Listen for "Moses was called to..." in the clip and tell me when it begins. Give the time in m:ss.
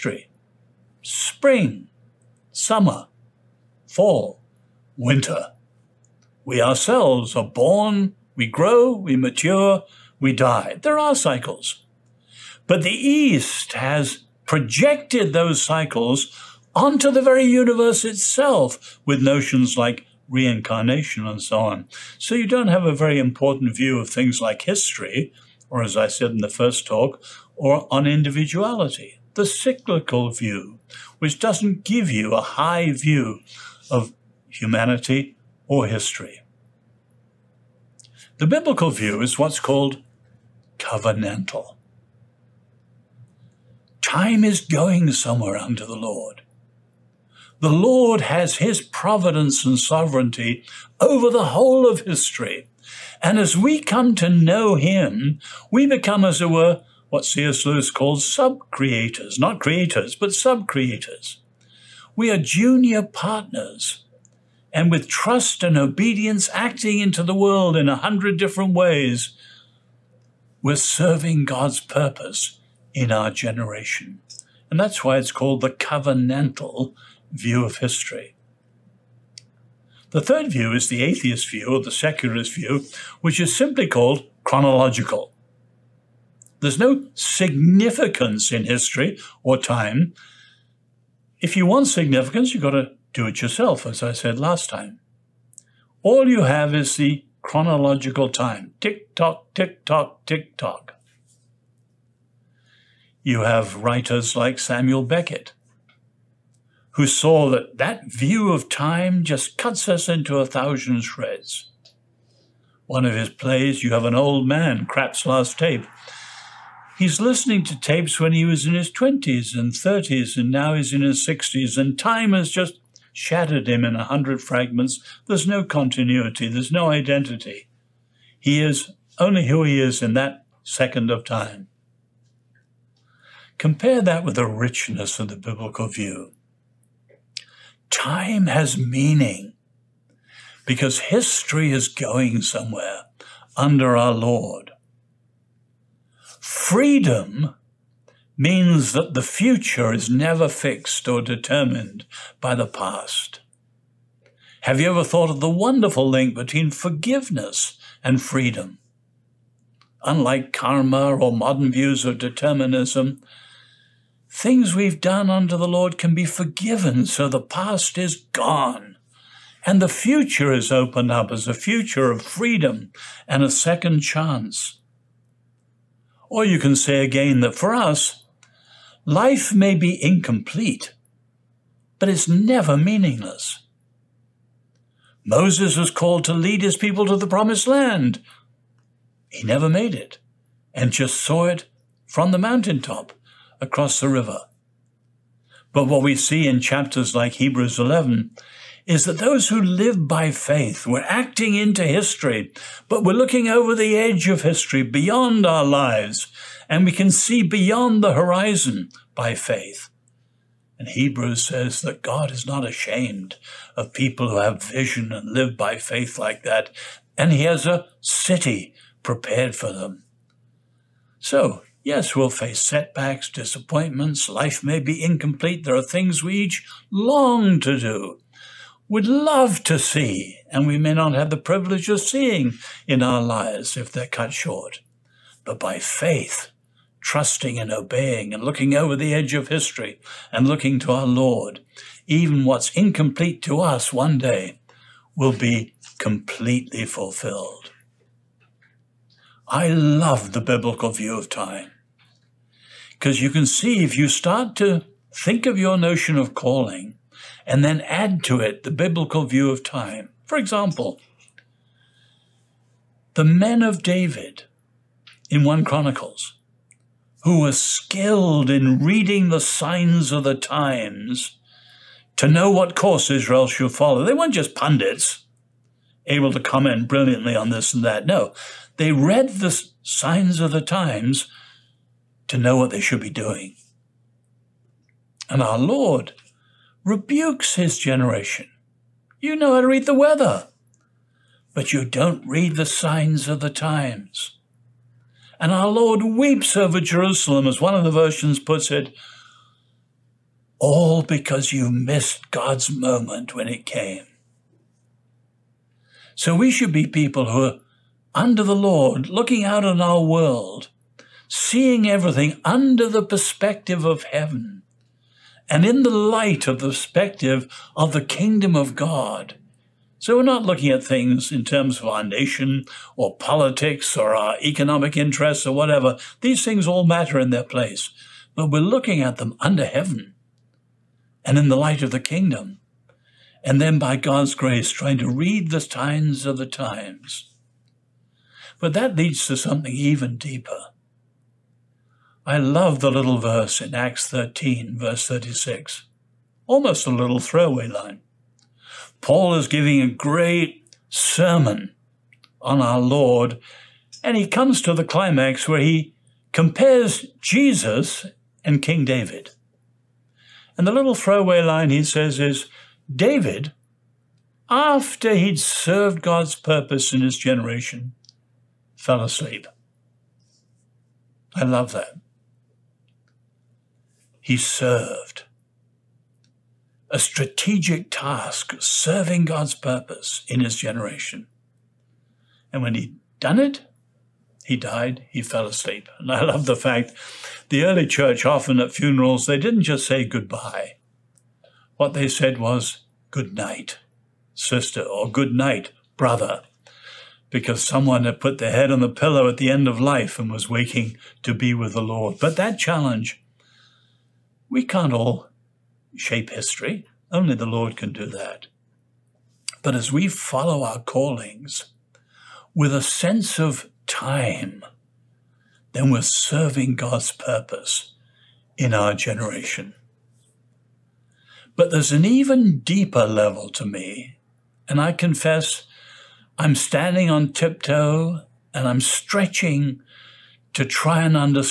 3:05.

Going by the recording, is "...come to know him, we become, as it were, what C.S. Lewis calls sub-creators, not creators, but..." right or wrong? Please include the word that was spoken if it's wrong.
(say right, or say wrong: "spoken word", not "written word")
right.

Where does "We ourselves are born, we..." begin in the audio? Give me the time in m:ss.
0:06.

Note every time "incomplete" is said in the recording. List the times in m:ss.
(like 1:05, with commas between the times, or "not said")
3:00, 3:45, 4:02.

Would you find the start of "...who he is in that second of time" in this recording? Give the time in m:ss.
2:09.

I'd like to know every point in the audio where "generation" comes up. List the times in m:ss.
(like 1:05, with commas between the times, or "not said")
1:13, 4:47, 6:07, 6:20, 6:58.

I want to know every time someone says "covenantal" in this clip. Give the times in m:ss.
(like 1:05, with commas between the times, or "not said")
0:40, 1:15.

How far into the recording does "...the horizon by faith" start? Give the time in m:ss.
3:28.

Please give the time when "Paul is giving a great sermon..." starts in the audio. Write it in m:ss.
5:49.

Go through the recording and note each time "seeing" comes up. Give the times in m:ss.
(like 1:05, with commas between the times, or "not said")
3:52, 5:11.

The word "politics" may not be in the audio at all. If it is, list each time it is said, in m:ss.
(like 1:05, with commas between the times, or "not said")
5:23.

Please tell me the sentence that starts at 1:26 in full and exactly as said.
There's no significance in history or time.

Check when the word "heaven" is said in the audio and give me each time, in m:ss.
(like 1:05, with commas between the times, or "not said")
5:14, 5:29.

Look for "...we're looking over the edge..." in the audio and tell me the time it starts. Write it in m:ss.
3:23.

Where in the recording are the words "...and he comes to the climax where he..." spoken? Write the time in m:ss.
5:54.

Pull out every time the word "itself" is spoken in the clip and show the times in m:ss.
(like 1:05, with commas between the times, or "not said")
0:18.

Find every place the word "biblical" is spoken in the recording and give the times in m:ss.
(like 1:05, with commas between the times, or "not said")
0:38, 2:15, 4:10, 4:18.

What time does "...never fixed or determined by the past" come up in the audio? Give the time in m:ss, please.
2:30.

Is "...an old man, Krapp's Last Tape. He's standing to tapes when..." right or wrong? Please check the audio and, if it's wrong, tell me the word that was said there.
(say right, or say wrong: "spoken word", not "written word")
wrong: "listening", not "standing".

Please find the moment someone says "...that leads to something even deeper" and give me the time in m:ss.
5:38.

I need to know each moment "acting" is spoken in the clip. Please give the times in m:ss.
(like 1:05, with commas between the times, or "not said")
1:06, 3:21.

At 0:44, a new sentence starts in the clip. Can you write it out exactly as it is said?
Time is going somewhere under the Lord.